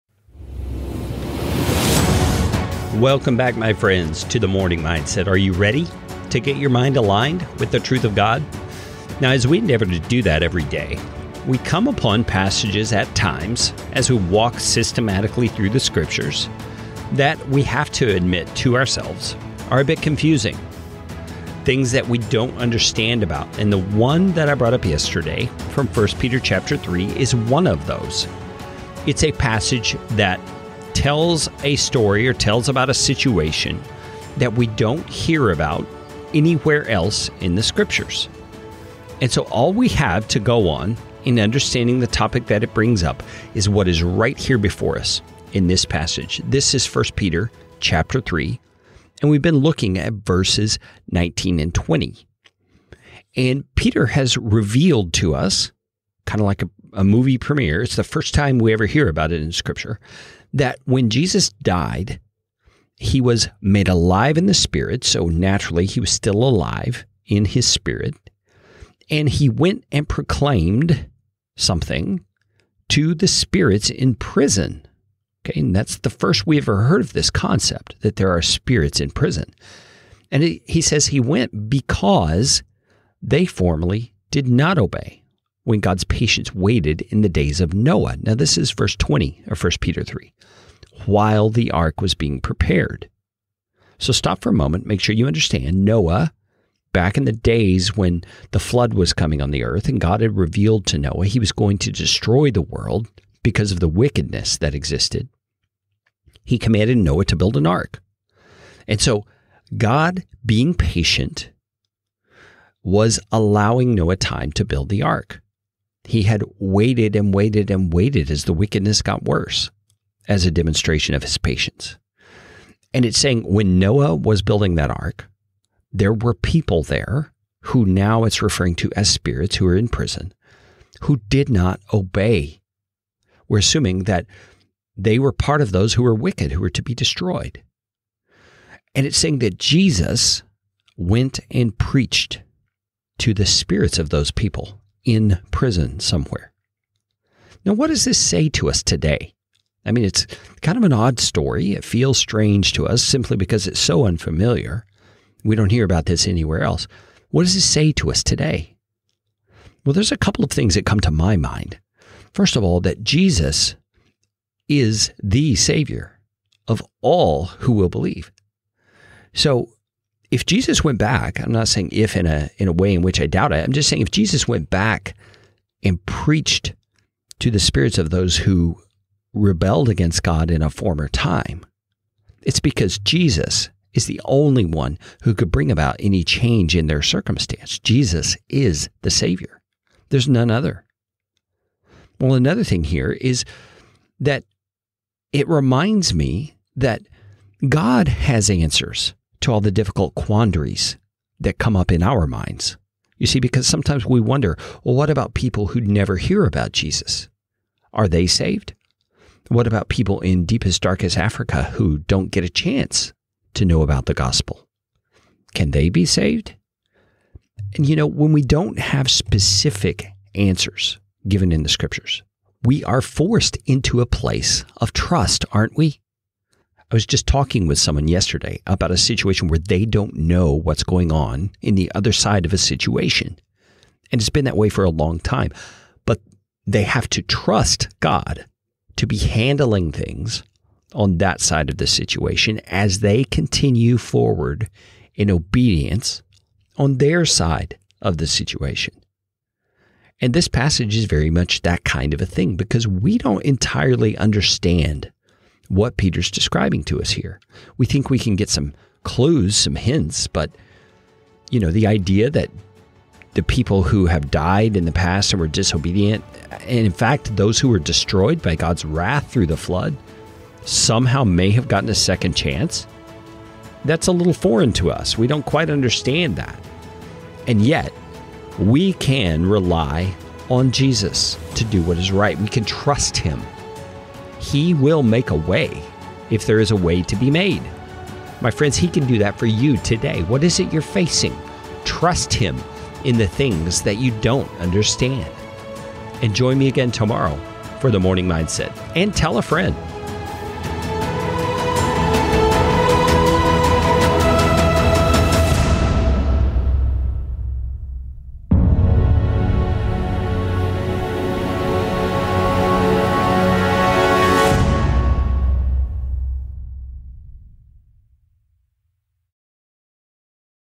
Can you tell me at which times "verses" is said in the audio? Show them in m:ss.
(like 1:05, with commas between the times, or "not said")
0:50, 1:28.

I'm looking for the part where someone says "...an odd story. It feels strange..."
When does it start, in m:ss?
2:30.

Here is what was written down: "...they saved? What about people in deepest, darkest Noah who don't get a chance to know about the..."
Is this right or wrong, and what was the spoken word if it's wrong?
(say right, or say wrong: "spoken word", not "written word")
wrong: "Africa", not "Noah".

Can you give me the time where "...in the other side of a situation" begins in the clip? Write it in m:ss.
3:51.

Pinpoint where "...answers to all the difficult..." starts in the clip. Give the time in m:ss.
3:18.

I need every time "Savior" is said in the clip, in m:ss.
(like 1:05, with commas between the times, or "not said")
2:45, 3:09.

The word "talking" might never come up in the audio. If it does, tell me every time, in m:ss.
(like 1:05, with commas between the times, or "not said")
3:47.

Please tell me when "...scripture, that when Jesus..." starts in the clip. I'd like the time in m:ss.
0:59.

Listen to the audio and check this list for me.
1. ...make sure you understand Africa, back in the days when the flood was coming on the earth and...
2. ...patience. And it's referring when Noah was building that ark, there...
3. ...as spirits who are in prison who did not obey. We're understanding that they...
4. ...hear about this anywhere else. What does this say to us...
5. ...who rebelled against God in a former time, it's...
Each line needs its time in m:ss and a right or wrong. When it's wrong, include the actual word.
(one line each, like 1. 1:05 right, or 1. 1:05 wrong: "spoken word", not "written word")
1. 1:34 wrong: "Noah", not "Africa"
2. 2:01 wrong: "saying", not "referring"
3. 2:08 wrong: "assuming", not "understanding"
4. 2:35 right
5. 2:58 right.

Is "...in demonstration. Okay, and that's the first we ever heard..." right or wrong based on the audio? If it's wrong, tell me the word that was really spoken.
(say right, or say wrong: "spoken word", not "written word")
wrong: "prison", not "demonstration".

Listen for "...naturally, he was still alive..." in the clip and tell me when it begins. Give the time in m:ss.
1:05.